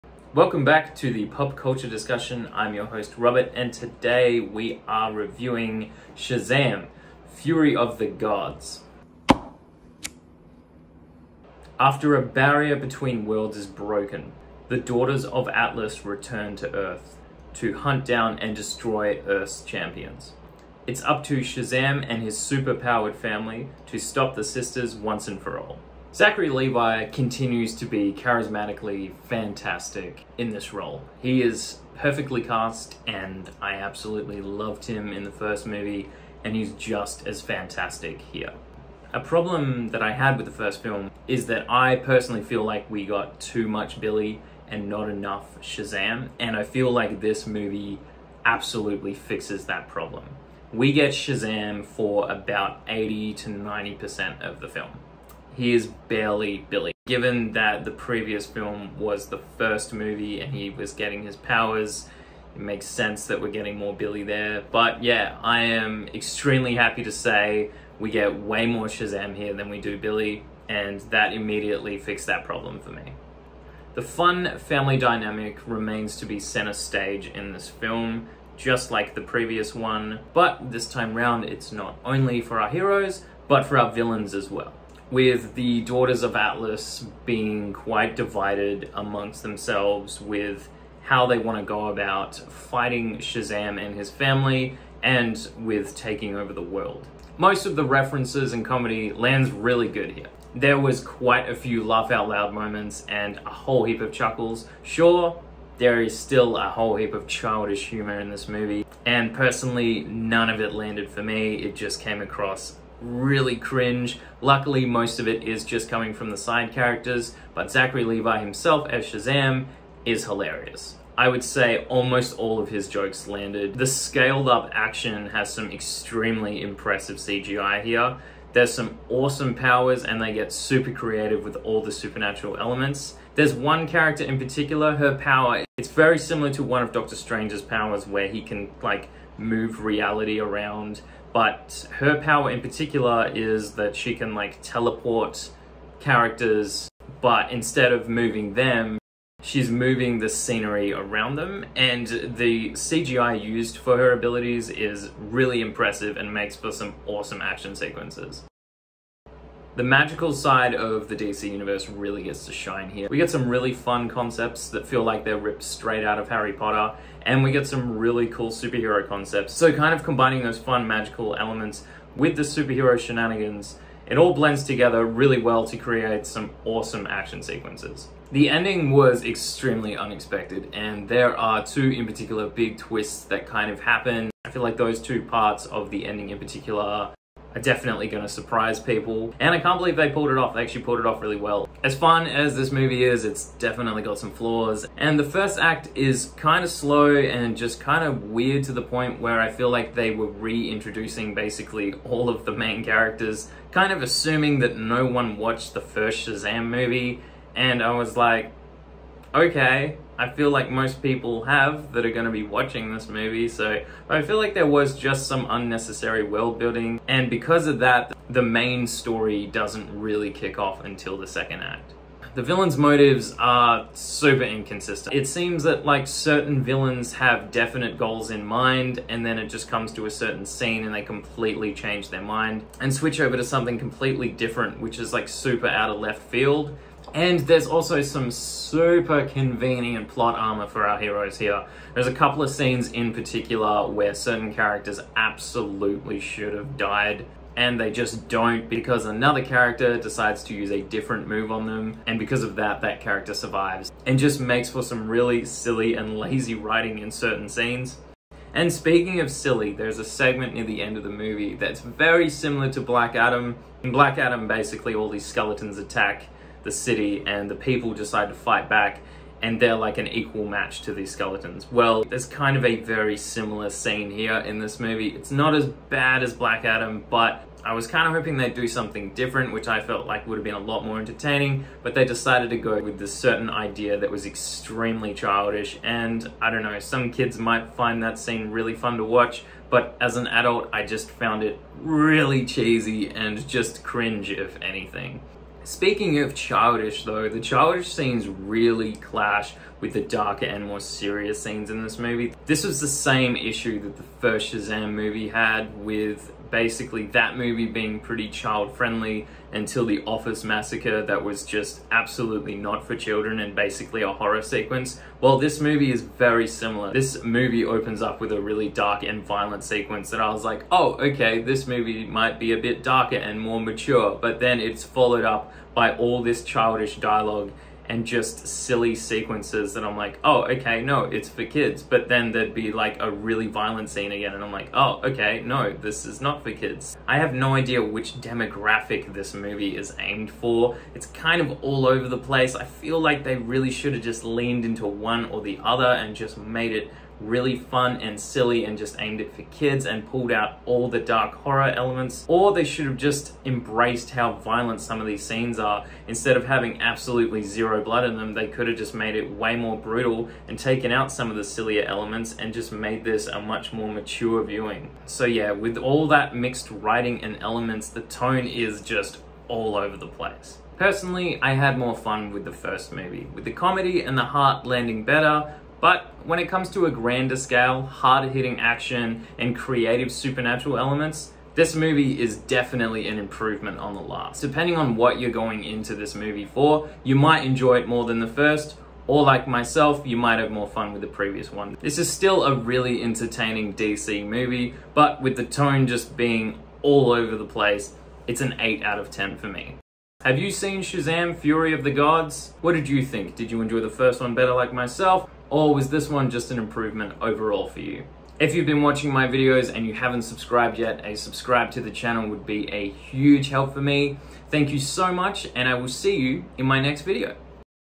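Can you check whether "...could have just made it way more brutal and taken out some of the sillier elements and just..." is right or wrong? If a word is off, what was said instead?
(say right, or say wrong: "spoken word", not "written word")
right.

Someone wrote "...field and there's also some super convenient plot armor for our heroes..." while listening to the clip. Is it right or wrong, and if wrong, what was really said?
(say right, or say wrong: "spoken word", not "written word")
right.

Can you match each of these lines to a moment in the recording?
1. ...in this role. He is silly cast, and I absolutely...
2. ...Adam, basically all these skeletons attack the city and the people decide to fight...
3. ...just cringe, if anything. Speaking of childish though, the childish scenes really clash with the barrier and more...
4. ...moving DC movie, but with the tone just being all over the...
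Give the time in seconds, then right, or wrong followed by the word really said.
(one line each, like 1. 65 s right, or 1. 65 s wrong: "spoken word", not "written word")
1. 30 s wrong: "perfectly", not "silly"
2. 264 s right
3. 293 s wrong: "darker", not "barrier"
4. 393 s wrong: "entertaining", not "moving".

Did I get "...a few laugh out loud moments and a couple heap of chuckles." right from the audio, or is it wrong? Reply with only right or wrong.
wrong.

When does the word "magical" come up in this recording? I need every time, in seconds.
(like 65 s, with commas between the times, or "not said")
159 s, 170 s.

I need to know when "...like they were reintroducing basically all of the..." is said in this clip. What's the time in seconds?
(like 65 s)
199 s.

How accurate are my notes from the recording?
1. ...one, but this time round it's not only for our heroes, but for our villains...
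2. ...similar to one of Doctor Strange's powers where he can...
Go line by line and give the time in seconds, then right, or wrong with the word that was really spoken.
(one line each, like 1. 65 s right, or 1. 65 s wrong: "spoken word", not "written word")
1. 79 s right
2. 136 s right.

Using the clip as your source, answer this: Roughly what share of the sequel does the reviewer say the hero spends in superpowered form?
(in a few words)
80 to 90%.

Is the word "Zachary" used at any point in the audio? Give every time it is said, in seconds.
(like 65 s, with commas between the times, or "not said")
26 s, 117 s.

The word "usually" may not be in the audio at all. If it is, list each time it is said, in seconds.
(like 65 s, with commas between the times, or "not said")
not said.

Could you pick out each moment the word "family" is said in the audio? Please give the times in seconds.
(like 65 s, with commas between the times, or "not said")
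23 s, 74 s, 94 s.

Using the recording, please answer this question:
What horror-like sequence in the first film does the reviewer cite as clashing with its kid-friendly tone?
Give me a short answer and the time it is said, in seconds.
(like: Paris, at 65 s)
The Office Massacre, at 309 s.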